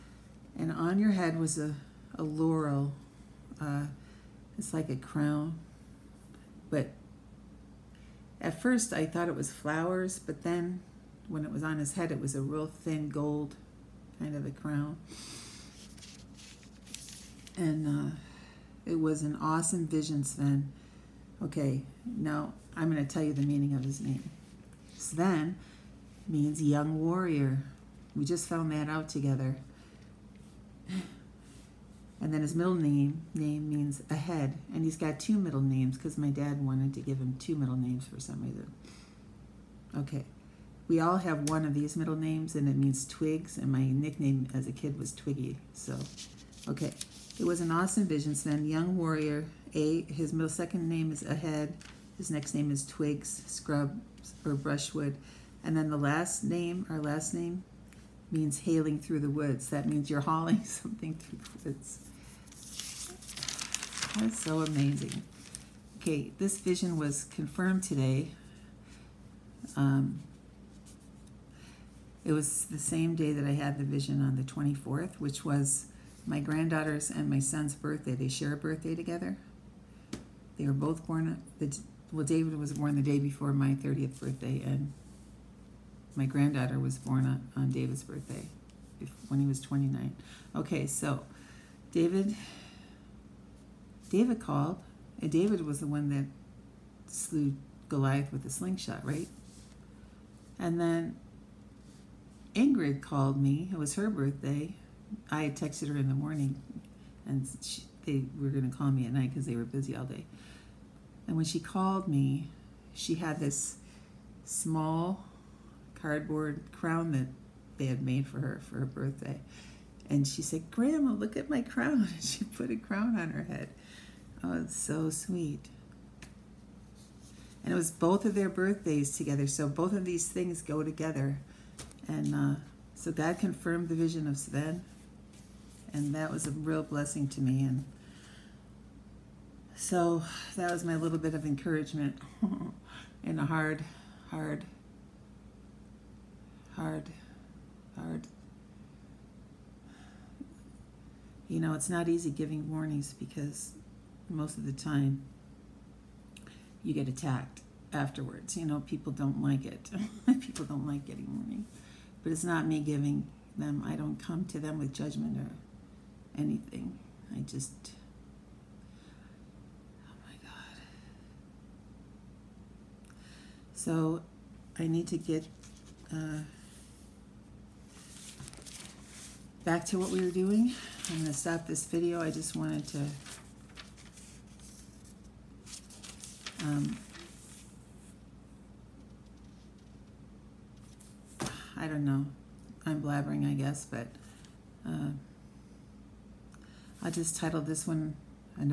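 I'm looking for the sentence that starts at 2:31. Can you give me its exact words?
You know, it's not easy giving warnings because most of the time you get attacked afterwards.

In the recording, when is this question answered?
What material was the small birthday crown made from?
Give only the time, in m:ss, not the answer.
1:56.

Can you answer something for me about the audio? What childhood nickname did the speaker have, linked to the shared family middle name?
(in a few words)
Twiggy.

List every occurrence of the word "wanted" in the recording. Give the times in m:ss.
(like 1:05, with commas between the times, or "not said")
0:36, 3:02.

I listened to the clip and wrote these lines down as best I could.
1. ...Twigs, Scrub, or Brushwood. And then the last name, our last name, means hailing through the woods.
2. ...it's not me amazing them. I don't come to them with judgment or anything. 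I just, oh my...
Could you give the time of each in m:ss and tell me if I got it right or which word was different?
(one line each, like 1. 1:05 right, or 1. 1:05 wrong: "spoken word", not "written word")
1. 0:52 right
2. 2:42 wrong: "giving", not "amazing".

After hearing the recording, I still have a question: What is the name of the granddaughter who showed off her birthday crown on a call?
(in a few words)
Ingrid.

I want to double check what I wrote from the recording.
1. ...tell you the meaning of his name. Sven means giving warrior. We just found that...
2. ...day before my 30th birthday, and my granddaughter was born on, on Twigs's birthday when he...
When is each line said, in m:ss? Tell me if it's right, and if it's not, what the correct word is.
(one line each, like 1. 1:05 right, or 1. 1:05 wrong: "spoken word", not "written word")
1. 0:23 wrong: "young", not "giving"
2. 1:23 wrong: "David", not "Twigs".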